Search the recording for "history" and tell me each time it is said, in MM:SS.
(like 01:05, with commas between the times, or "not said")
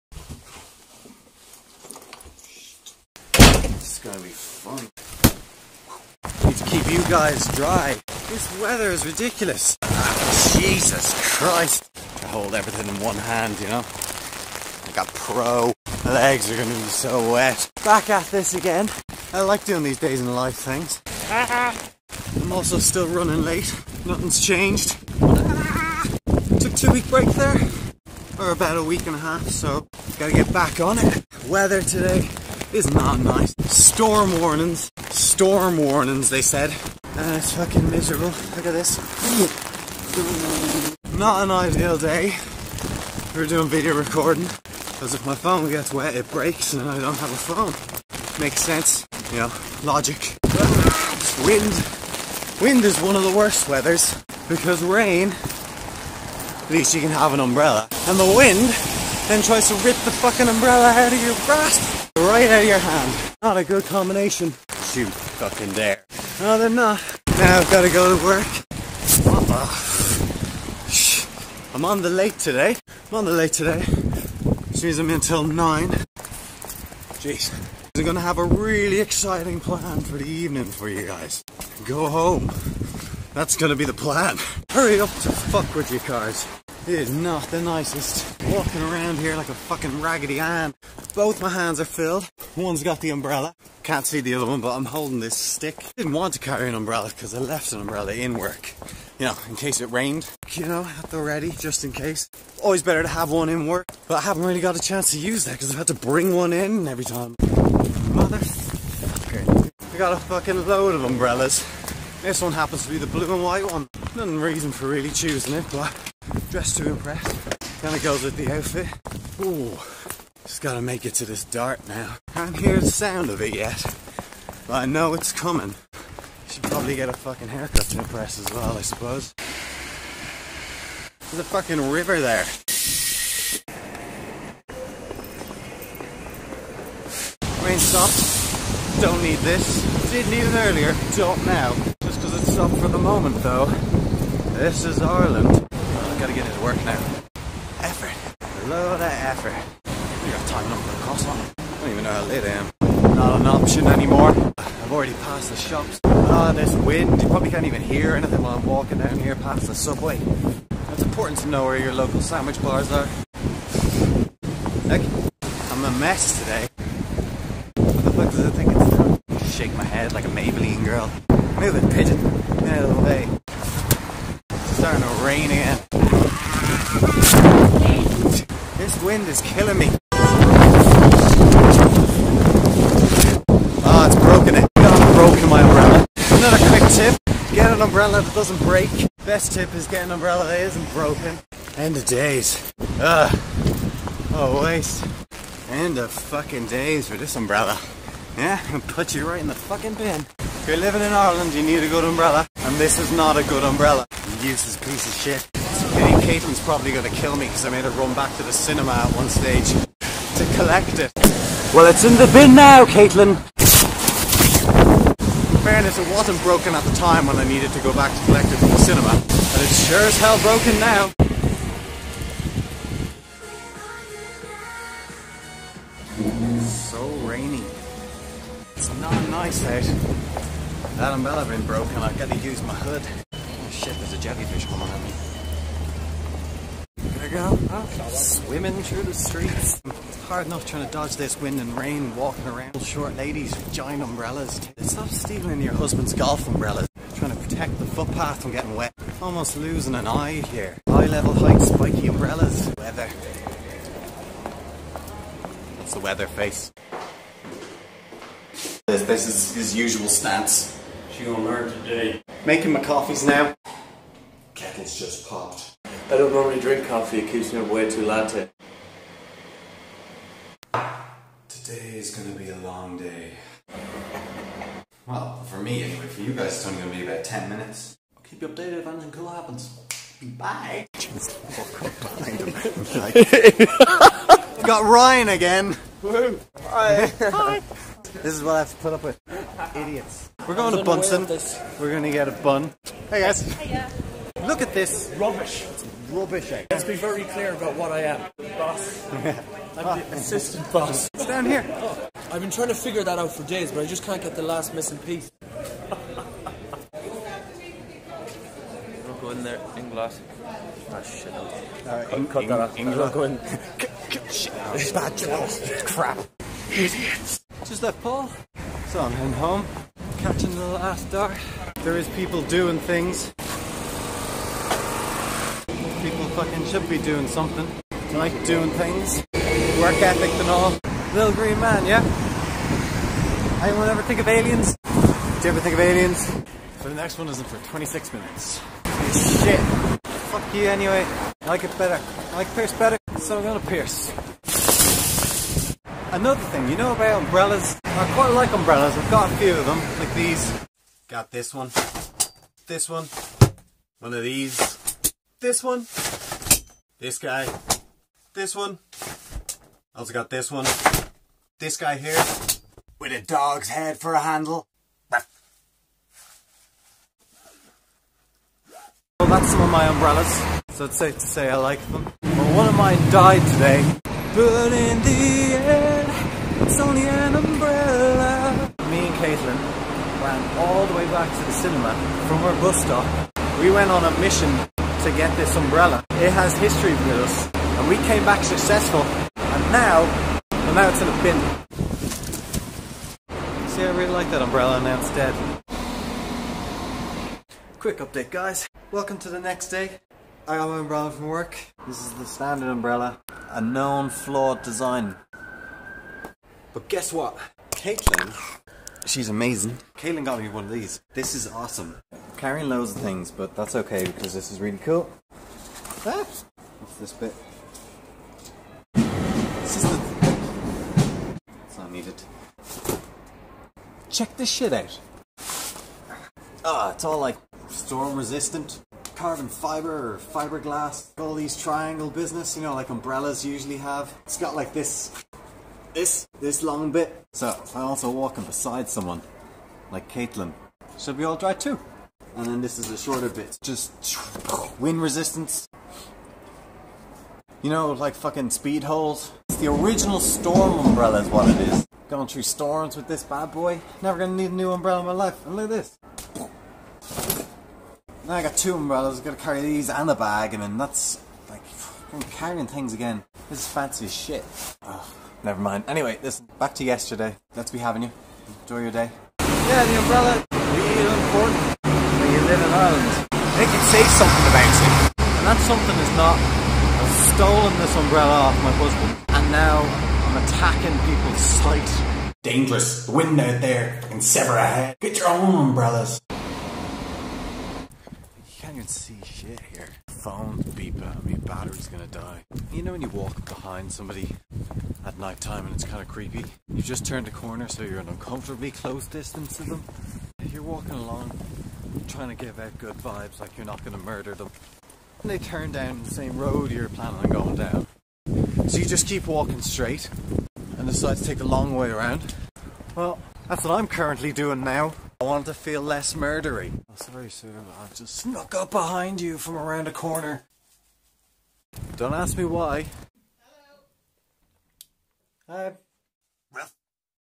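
06:26.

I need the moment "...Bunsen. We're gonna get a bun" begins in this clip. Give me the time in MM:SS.
04:50.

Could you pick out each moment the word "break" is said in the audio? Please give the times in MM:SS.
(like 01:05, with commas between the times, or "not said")
00:27, 00:46, 03:08.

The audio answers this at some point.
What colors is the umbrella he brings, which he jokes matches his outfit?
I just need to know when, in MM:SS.
01:53.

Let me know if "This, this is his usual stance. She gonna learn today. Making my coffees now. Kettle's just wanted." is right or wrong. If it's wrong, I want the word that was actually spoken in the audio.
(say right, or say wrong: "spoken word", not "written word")
wrong: "popped", not "wanted".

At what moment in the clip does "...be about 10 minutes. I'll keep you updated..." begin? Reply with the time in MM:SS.
04:36.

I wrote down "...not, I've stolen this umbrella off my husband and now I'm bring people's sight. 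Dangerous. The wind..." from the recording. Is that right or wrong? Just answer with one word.
wrong.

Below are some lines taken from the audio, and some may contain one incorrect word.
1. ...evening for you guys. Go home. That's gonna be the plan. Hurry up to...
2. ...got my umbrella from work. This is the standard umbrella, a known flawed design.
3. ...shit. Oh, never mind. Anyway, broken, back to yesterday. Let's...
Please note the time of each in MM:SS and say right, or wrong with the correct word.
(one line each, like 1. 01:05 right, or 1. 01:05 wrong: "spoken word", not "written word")
1. 01:20 right
2. 06:40 right
3. 07:44 wrong: "listen", not "broken".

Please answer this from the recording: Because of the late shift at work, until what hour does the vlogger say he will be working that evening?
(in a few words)
9.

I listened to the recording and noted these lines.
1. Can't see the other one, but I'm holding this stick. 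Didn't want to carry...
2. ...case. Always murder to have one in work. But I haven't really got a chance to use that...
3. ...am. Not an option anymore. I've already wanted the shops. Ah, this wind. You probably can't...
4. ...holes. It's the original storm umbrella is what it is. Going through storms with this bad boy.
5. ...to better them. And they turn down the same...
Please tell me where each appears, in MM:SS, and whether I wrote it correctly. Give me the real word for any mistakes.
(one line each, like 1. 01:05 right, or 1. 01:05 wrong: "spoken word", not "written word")
1. 01:33 right
2. 01:41 wrong: "better", not "murder"
3. 02:32 wrong: "passed", not "wanted"
4. 07:28 right
5. 08:23 wrong: "murder", not "better".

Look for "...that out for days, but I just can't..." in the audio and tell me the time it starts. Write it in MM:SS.
05:03.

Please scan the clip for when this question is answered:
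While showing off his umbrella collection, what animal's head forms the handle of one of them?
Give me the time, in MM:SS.
06:03.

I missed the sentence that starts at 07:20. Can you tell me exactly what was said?
Should be all dry too and then this is a shorter bit.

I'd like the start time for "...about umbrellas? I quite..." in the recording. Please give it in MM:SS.
05:46.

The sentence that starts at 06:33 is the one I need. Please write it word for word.
See, I really like that umbrella and now it's dead.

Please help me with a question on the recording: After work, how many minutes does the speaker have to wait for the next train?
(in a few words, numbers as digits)
26.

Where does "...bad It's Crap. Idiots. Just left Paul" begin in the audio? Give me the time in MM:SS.
05:14.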